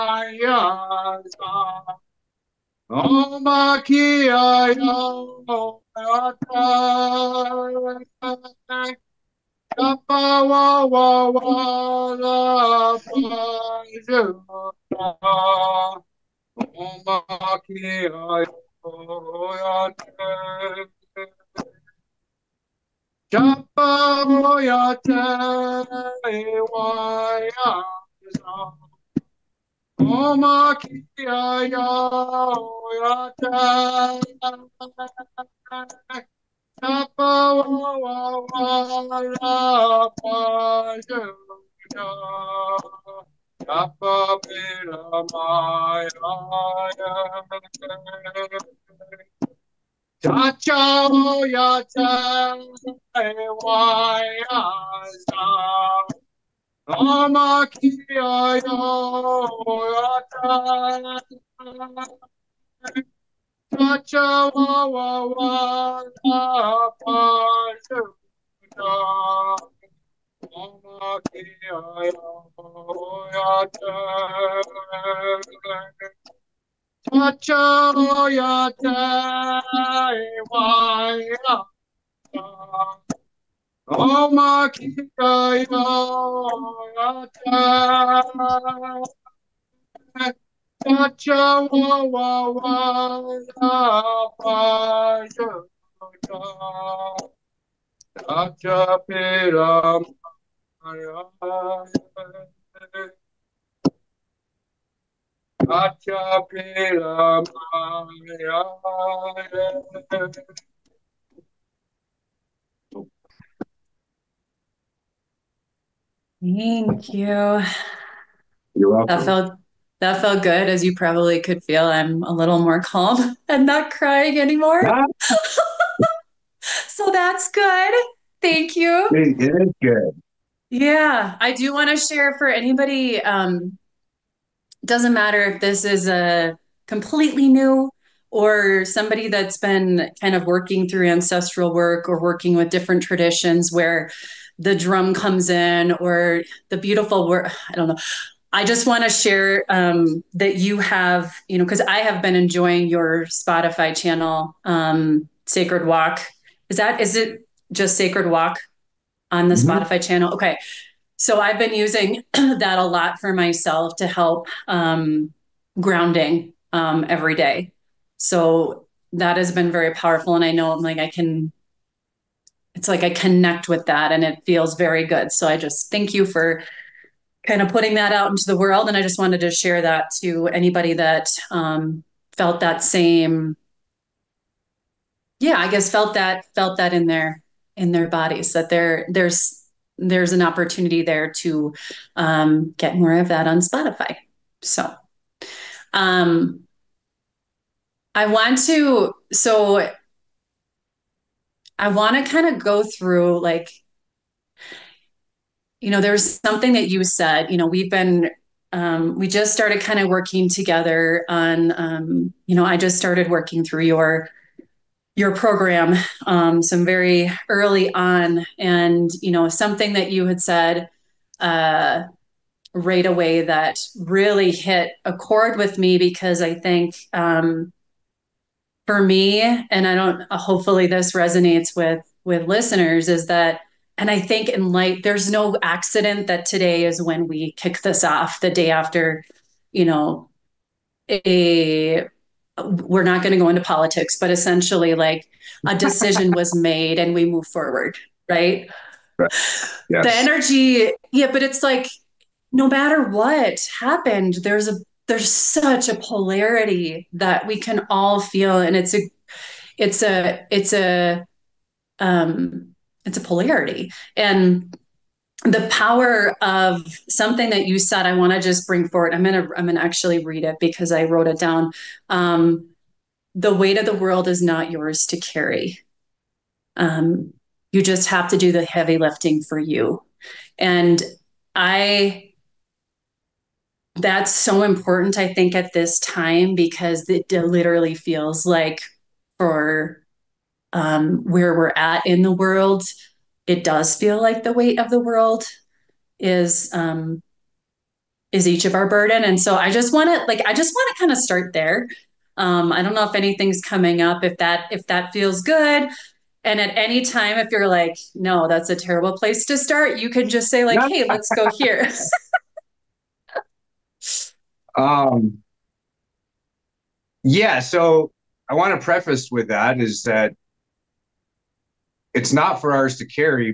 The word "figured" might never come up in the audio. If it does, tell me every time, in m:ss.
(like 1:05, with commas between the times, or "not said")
not said.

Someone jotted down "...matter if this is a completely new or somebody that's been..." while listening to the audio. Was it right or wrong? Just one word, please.
right.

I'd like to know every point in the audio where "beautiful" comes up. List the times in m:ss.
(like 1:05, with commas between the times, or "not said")
2:26.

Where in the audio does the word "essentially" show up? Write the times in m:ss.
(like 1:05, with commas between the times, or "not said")
4:04.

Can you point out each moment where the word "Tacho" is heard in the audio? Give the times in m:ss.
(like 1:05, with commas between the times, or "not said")
0:50, 1:03.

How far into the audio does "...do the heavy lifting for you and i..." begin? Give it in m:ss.
4:38.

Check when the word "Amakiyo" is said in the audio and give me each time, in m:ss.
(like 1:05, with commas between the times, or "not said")
0:56, 1:10.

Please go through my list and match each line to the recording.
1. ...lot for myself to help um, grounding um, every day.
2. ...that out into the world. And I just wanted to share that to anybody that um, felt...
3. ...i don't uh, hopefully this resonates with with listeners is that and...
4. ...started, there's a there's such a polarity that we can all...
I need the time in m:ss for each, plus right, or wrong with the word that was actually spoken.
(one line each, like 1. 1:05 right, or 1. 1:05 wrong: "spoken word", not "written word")
1. 2:42 right
2. 2:57 right
3. 3:49 right
4. 4:13 wrong: "happened", not "started".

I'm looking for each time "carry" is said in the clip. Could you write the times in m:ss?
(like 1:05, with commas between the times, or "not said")
4:35, 5:23.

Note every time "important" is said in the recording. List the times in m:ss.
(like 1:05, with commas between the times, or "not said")
4:44.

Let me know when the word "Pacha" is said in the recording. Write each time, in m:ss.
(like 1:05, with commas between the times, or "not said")
1:17, 1:30, 1:38.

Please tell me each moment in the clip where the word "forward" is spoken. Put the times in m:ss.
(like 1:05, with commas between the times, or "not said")
4:07, 4:28.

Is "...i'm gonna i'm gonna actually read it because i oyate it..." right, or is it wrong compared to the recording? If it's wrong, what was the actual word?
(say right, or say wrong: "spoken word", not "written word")
wrong: "wrote", not "oyate".